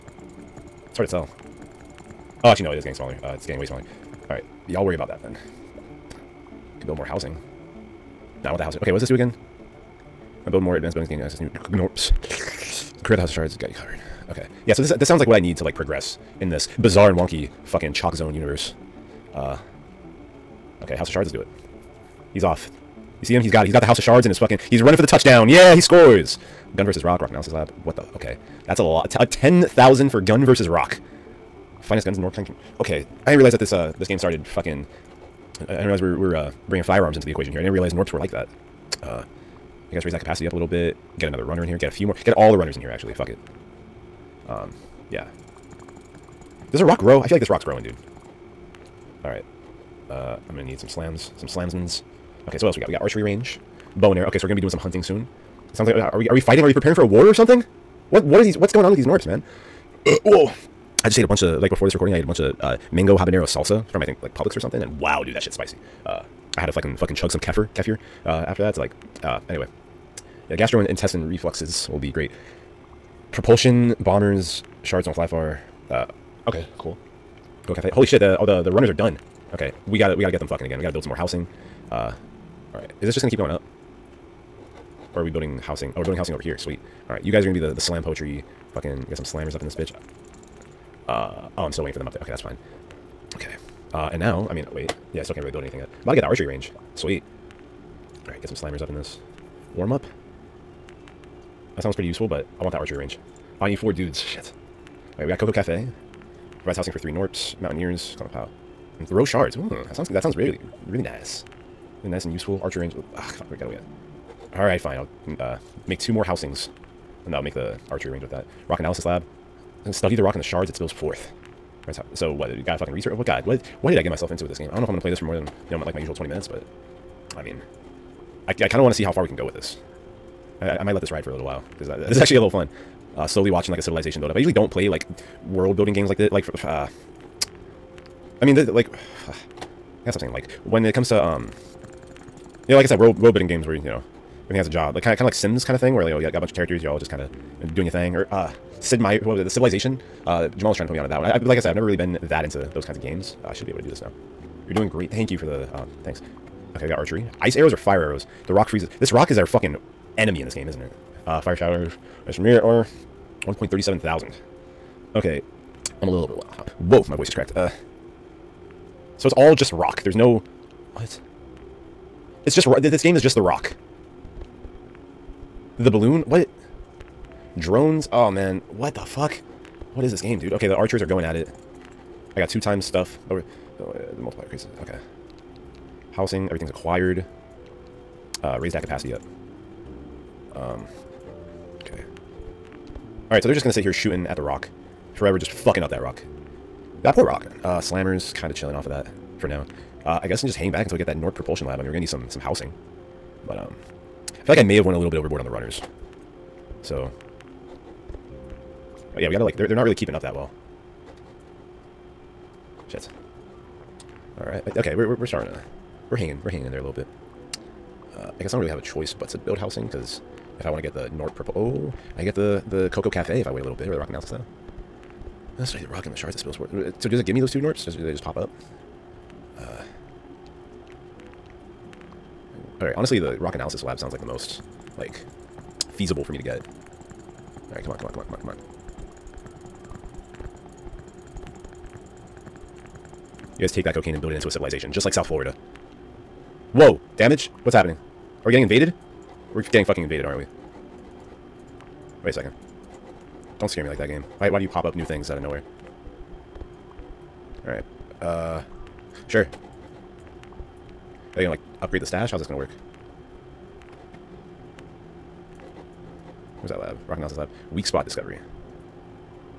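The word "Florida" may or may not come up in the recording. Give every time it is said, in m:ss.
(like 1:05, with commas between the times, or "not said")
4:05.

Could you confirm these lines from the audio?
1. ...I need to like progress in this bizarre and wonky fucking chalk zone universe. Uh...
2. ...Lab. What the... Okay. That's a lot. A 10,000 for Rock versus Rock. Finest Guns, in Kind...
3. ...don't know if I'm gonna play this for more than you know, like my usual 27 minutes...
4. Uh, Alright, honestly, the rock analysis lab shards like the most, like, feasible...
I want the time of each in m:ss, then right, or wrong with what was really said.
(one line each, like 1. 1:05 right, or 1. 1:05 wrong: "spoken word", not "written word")
1. 0:15 right
2. 0:27 wrong: "Gun", not "Rock"
3. 2:04 wrong: "20", not "27"
4. 3:49 wrong: "sounds", not "shards".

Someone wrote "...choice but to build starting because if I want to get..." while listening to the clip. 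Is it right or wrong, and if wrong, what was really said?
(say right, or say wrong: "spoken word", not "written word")
wrong: "housing", not "starting".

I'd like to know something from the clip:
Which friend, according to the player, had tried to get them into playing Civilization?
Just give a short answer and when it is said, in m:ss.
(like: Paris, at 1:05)
Jamal, at 2:30.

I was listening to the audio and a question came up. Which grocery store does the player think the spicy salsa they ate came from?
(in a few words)
Publix.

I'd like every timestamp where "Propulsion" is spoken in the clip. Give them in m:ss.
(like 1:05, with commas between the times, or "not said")
1:13, 3:21.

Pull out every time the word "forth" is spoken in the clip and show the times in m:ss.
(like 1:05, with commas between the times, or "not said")
2:00, 3:46.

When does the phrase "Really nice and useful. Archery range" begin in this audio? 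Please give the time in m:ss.
1:52.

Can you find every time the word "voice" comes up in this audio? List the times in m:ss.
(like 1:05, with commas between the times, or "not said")
2:47.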